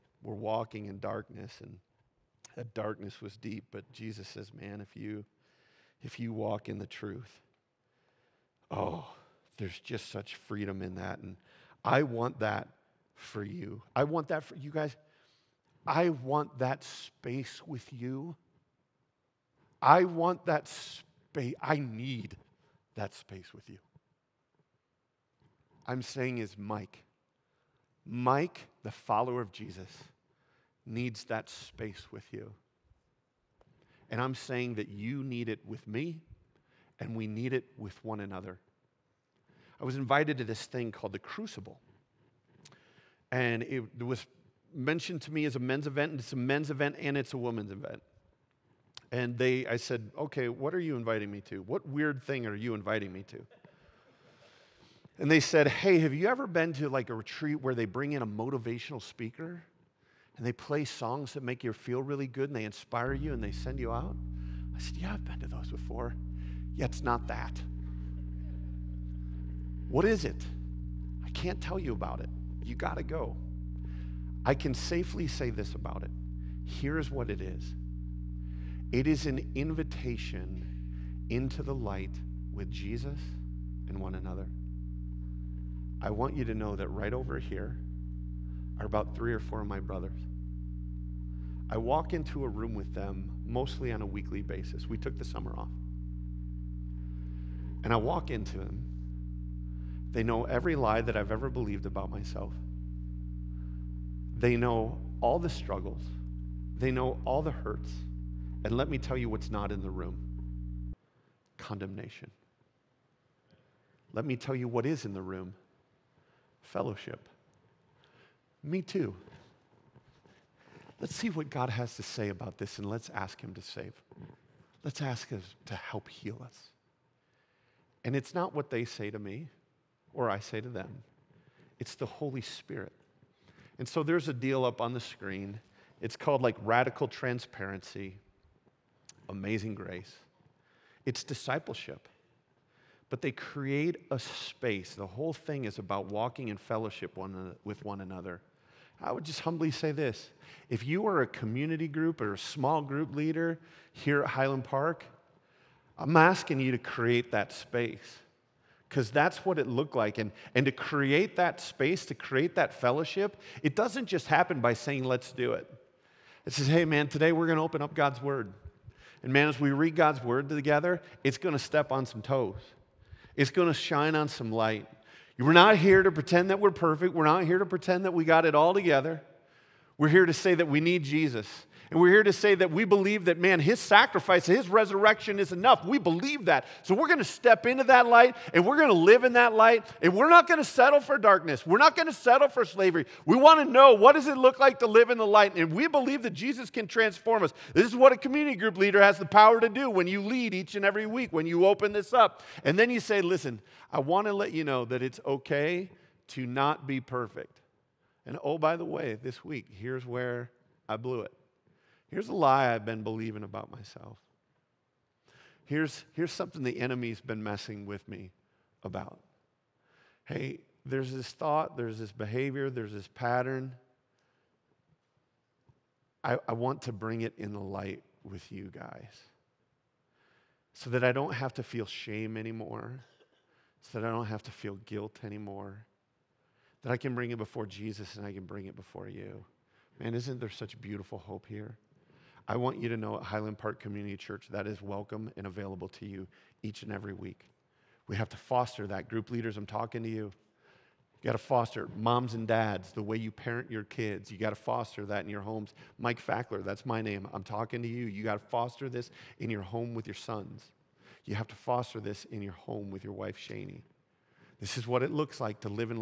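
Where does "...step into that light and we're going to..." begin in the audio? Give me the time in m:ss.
3:07.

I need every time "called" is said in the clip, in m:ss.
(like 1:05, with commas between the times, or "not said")
0:40, 2:16.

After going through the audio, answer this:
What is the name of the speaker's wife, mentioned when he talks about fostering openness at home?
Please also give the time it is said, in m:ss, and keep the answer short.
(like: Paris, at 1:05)
Shani, at 4:23.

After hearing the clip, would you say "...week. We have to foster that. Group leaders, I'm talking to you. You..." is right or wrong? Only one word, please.
right.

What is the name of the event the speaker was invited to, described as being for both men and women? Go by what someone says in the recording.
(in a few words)
The Crucible.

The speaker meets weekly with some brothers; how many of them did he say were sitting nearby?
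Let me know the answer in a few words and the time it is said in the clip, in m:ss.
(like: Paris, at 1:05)
3 or 4, at 1:29.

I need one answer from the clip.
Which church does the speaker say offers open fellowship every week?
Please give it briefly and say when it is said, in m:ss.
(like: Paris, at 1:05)
Highland Park Community Church, at 4:03.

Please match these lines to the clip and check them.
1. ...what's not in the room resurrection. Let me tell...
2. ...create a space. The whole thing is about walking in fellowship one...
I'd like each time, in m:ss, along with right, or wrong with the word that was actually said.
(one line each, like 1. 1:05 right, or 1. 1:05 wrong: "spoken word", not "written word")
1. 1:49 wrong: "condemnation", not "resurrection"
2. 2:23 right.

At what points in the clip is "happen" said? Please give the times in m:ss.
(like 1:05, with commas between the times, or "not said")
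2:44.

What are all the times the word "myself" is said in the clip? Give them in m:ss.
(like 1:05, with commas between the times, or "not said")
1:42, 3:33.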